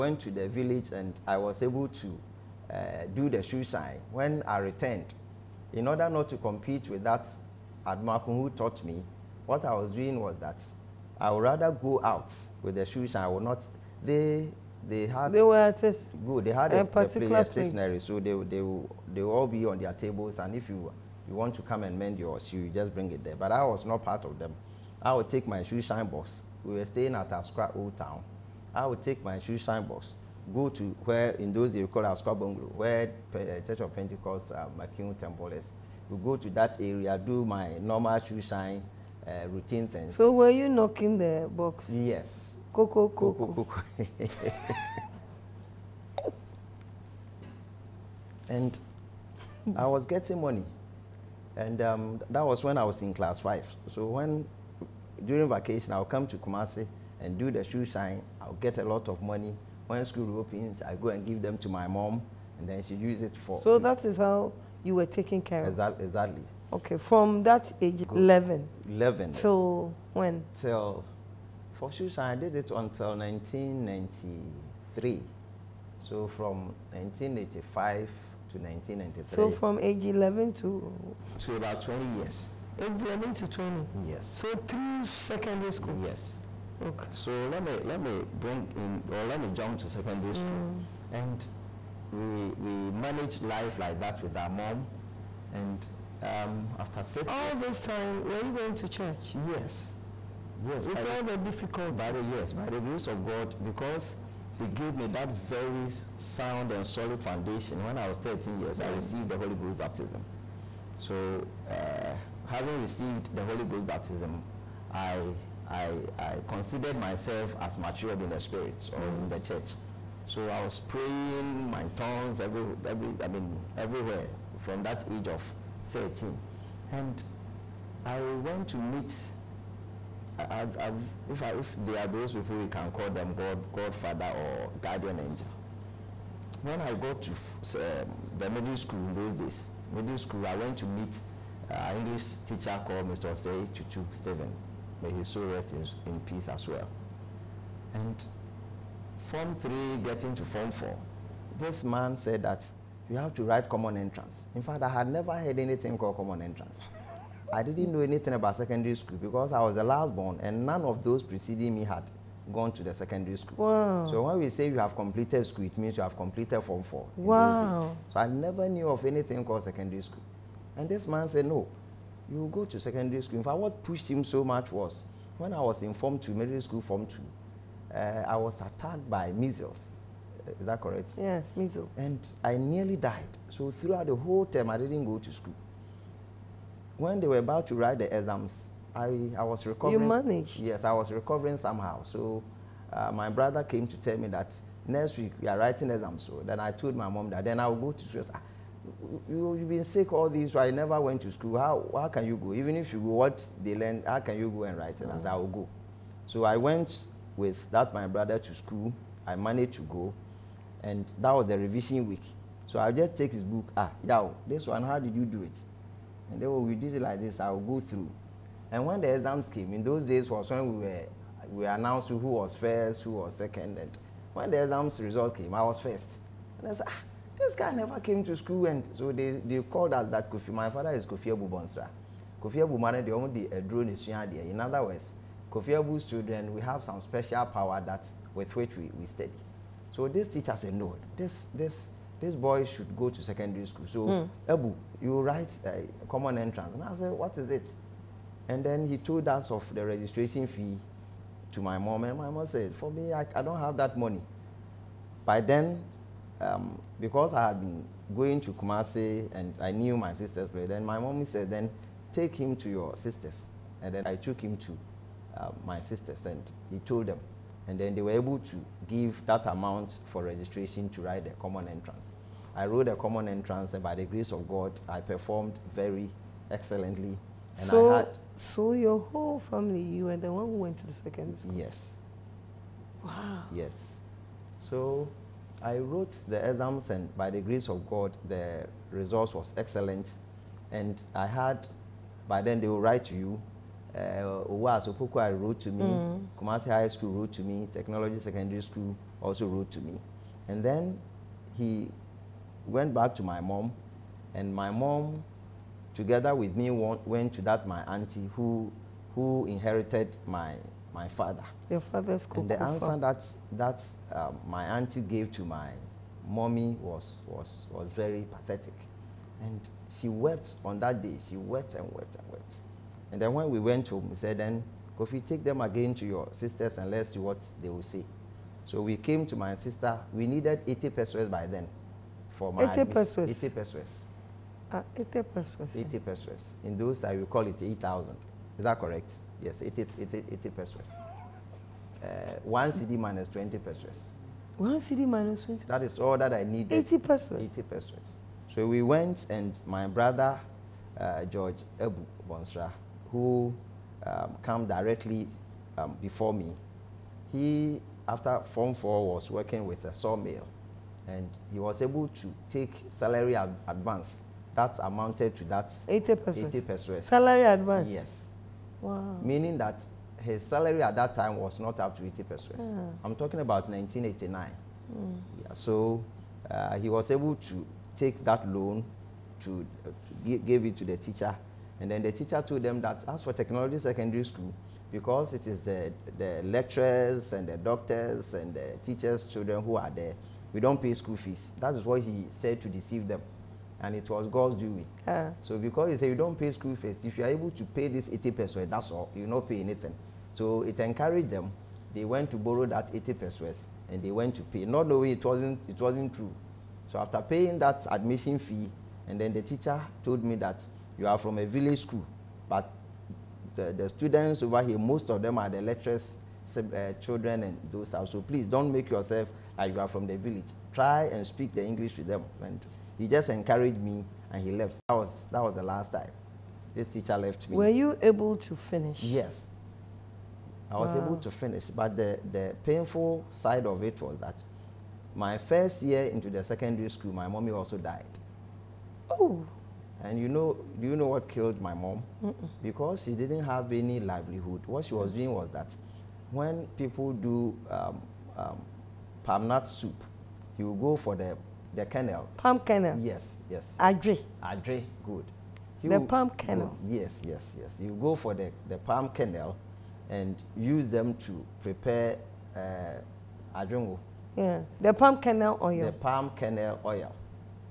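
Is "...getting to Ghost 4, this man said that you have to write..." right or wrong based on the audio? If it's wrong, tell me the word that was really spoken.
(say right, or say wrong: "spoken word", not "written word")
wrong: "Form", not "Ghost".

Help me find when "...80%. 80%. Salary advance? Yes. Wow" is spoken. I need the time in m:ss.
6:05.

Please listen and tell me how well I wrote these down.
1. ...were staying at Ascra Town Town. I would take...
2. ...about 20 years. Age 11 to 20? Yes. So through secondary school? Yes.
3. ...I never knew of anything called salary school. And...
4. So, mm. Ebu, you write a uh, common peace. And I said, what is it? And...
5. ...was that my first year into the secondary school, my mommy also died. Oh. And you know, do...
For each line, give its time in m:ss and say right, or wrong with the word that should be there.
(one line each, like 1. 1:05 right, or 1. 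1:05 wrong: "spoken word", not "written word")
1. 0:26 wrong: "Old", not "Town"
2. 1:21 right
3. 2:48 wrong: "secondary", not "salary"
4. 4:03 wrong: "entrance", not "peace"
5. 7:14 right.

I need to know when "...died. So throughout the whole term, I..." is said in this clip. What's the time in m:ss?
3:02.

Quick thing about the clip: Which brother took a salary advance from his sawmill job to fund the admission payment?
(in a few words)
George Ebu Bonsra.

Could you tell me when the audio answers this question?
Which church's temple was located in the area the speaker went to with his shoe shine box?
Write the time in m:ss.
0:34.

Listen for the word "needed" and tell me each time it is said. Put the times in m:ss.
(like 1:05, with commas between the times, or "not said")
5:30, 5:46.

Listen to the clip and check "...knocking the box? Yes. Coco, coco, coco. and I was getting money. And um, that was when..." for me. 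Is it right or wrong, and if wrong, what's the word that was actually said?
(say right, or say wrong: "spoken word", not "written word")
right.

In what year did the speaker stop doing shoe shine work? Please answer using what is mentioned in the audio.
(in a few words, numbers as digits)
1993.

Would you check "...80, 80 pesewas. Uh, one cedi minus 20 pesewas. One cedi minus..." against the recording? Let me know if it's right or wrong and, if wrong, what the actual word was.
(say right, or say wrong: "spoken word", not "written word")
right.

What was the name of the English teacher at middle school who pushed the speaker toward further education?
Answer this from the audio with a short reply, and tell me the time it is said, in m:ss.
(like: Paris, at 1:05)
Osei Chuchu Stephen, at 2:23.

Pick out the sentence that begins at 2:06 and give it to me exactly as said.
And I went to meet if, I, if they are those people, we can call them God, Godfather or guardian angel.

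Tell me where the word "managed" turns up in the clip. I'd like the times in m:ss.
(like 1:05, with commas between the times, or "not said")
1:32, 3:10, 3:29.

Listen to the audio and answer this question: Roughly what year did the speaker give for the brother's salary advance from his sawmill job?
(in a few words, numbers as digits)
1989.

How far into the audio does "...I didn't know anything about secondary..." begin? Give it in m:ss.
2:37.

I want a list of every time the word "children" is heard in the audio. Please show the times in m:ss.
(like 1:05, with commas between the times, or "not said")
3:56, 6:29, 6:56.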